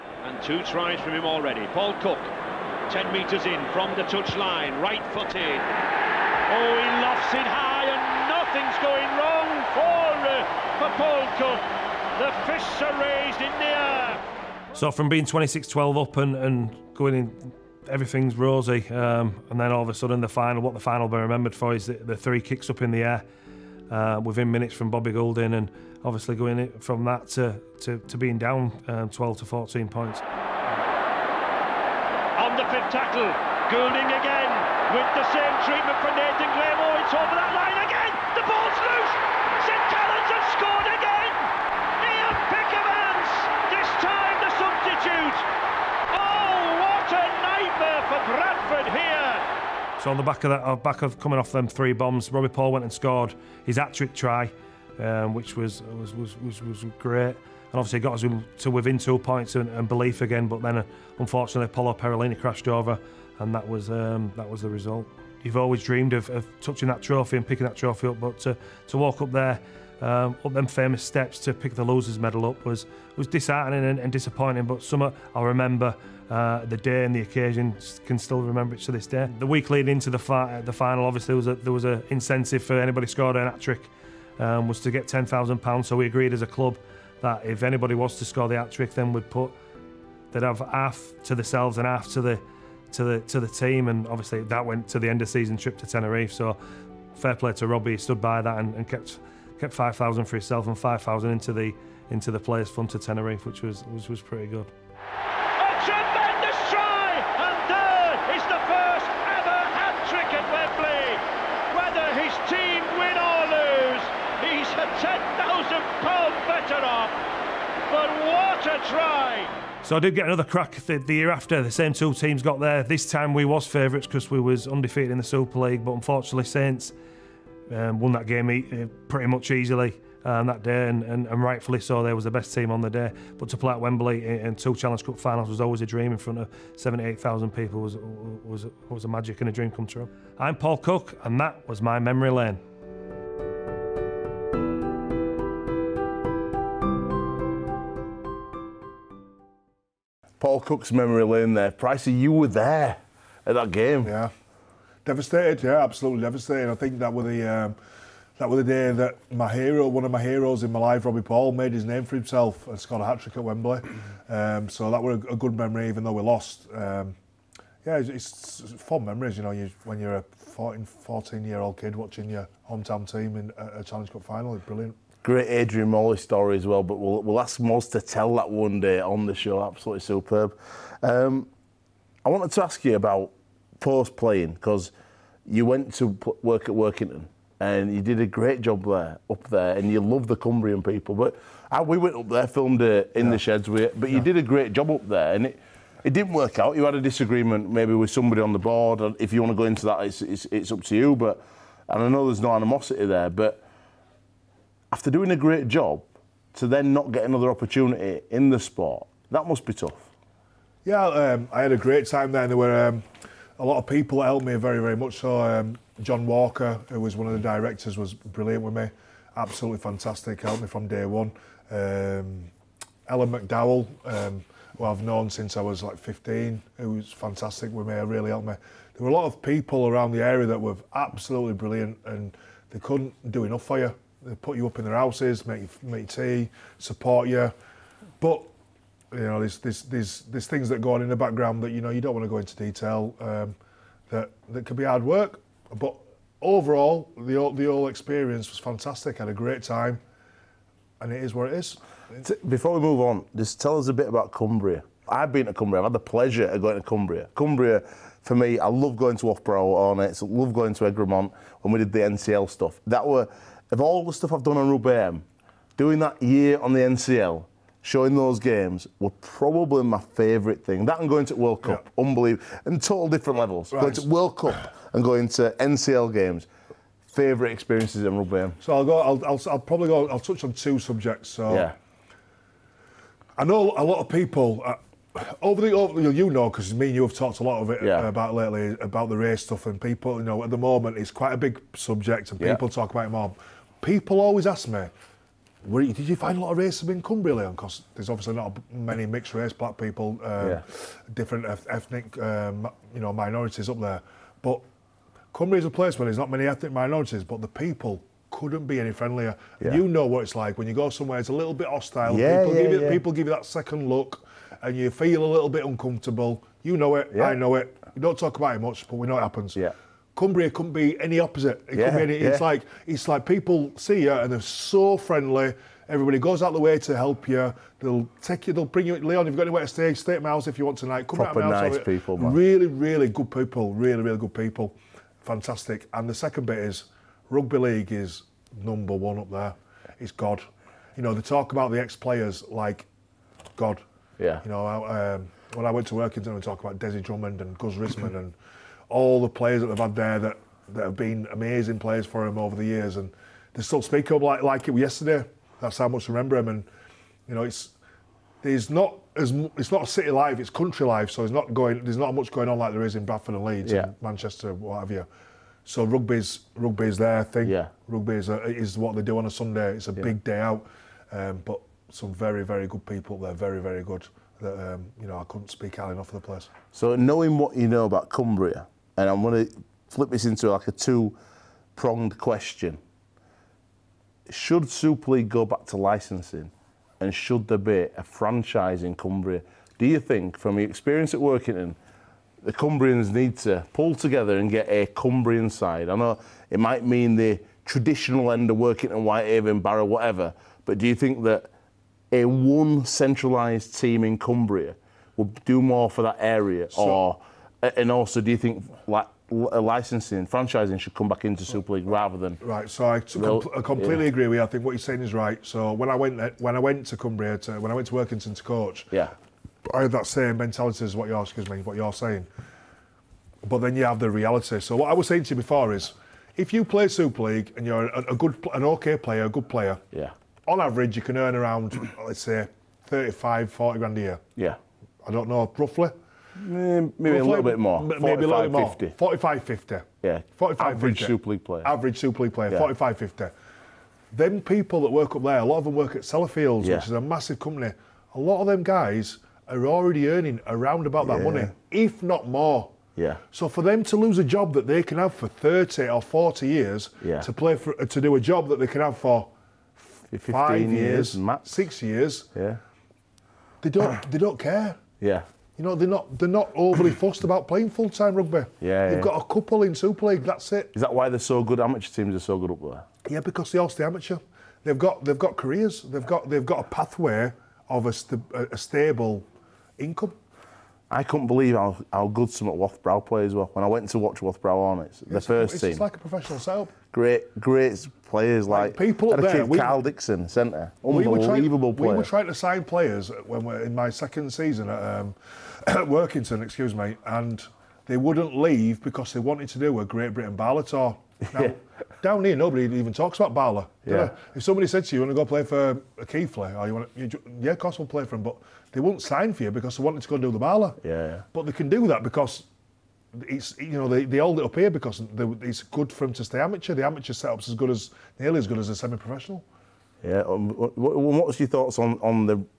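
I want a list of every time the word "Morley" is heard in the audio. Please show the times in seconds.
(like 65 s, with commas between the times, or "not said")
175 s.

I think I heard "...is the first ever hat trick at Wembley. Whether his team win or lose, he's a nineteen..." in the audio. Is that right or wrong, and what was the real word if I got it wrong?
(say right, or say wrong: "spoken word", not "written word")
wrong: "ten", not "nineteen".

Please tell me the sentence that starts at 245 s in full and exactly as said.
But overall, the, the whole experience was fantastic.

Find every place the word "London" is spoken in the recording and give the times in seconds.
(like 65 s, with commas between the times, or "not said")
not said.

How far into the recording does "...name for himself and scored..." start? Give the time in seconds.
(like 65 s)
161 s.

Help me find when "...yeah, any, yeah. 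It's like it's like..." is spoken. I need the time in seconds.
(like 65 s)
321 s.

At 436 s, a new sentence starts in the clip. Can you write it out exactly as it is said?
Eh, maybe we'll a little bit more.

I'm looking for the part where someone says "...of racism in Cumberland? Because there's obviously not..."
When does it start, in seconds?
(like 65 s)
296 s.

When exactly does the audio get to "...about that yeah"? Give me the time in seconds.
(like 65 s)
450 s.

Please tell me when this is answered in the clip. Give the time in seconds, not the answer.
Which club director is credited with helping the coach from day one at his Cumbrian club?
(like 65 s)
216 s.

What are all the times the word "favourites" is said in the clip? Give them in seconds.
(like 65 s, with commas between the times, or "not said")
123 s, 270 s, 277 s.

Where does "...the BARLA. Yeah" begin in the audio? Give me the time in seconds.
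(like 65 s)
510 s.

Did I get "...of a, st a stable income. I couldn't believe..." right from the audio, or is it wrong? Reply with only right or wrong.
right.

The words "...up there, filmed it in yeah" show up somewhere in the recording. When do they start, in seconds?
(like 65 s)
192 s.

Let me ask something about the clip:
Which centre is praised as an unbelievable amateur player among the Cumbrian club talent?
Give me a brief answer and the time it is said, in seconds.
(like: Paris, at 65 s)
Carl Dixon, at 489 s.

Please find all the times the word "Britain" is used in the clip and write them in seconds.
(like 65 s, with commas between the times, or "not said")
500 s.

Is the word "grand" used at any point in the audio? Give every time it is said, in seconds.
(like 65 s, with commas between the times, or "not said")
433 s.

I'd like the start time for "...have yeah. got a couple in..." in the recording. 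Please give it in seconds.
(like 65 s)
468 s.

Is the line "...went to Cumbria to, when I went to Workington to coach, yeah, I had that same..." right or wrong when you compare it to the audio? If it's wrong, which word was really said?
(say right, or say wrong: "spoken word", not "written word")
right.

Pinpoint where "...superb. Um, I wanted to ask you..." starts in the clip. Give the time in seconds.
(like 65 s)
180 s.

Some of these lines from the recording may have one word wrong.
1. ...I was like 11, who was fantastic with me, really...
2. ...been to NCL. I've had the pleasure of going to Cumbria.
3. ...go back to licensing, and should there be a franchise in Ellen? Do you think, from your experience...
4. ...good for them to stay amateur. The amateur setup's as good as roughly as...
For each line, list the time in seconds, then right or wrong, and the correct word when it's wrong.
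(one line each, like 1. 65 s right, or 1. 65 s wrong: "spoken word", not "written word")
1. 225 s wrong: "15", not "11"
2. 255 s wrong: "Cumbria", not "NCL"
3. 385 s wrong: "Cumbria", not "Ellen"
4. 515 s wrong: "nearly", not "roughly".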